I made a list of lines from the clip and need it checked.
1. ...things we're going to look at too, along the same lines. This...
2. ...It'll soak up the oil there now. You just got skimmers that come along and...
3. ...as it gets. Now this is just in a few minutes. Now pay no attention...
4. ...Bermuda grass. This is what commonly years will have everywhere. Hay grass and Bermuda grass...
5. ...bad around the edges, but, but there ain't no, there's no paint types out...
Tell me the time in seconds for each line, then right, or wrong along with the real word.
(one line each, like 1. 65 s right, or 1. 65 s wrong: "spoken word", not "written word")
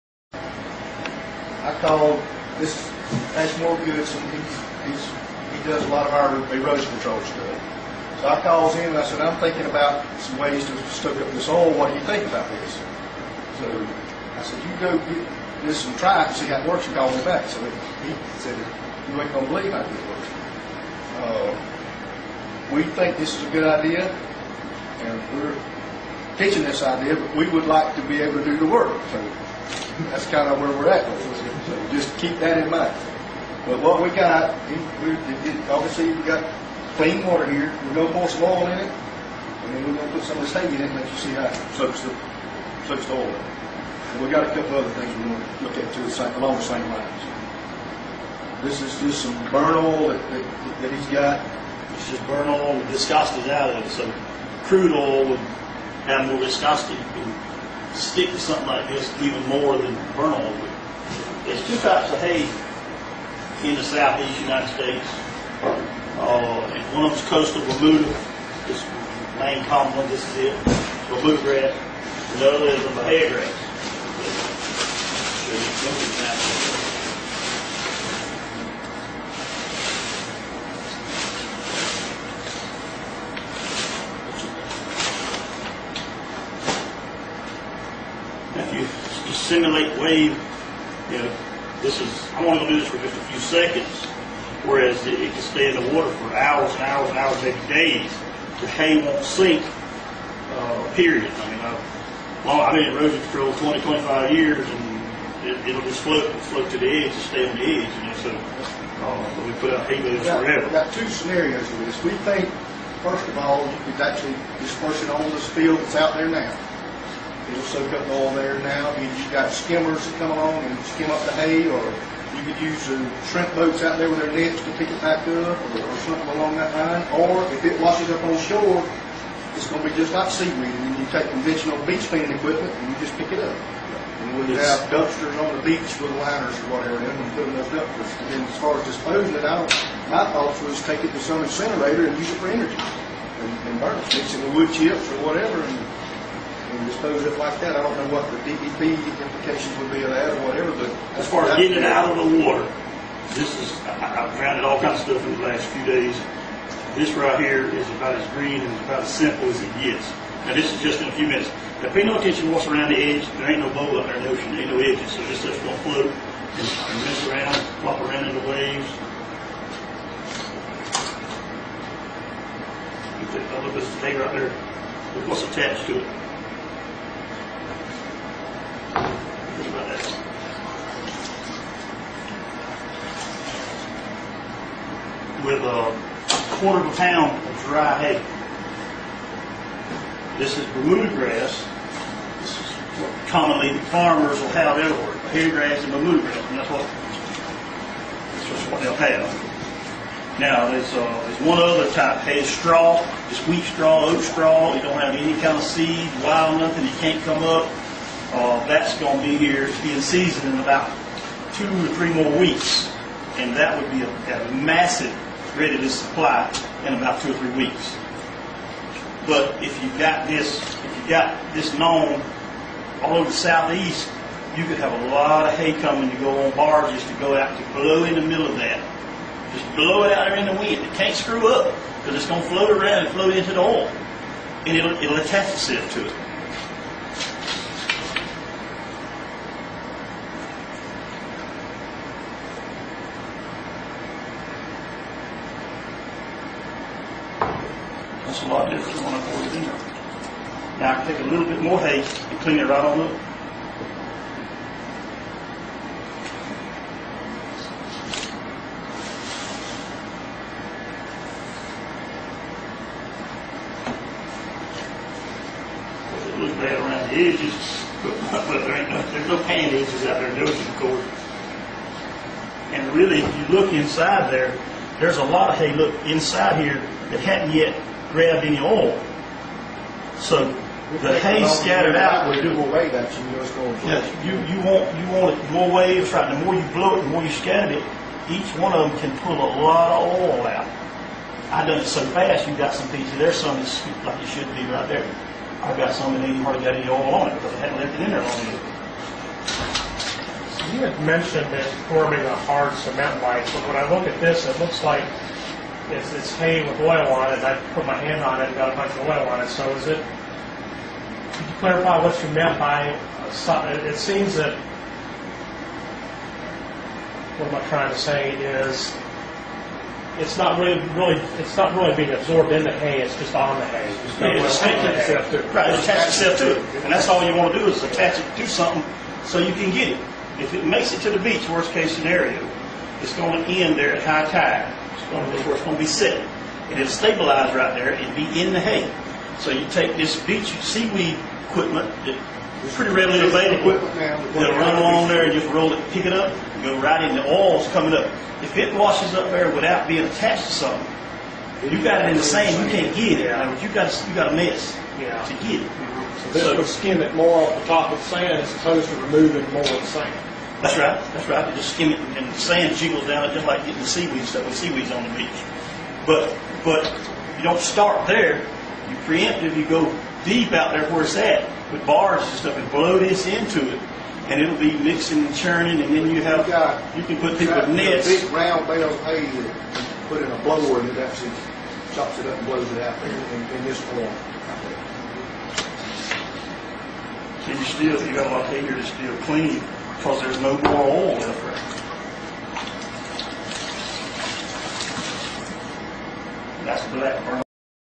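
1. 44 s right
2. 117 s right
3. 159 s right
4. 190 s wrong: "farmers", not "years"
5. 266 s wrong: "edges", not "types".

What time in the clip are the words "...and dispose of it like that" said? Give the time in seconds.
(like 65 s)
146 s.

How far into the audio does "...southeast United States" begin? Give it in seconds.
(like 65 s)
63 s.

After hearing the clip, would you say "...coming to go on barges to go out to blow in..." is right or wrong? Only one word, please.
right.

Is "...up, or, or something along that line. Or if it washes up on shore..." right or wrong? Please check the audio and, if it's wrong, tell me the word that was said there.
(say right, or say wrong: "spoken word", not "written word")
right.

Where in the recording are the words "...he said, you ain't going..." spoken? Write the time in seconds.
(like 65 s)
17 s.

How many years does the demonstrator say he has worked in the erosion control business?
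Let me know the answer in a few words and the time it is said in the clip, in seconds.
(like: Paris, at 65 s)
20 to 25 years, at 103 s.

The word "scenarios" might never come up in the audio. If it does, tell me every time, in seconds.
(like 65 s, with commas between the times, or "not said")
111 s, 331 s.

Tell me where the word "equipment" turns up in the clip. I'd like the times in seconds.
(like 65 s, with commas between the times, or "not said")
132 s, 341 s.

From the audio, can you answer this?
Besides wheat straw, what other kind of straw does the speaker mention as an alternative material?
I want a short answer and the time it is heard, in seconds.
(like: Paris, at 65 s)
Oat straw, at 204 s.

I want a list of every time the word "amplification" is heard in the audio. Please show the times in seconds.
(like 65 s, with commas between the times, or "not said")
not said.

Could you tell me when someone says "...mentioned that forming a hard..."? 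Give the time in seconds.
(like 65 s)
301 s.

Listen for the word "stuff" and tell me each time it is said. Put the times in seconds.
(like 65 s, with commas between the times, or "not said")
7 s, 155 s, 165 s, 364 s, 372 s.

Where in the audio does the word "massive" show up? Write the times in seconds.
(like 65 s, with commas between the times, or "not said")
214 s.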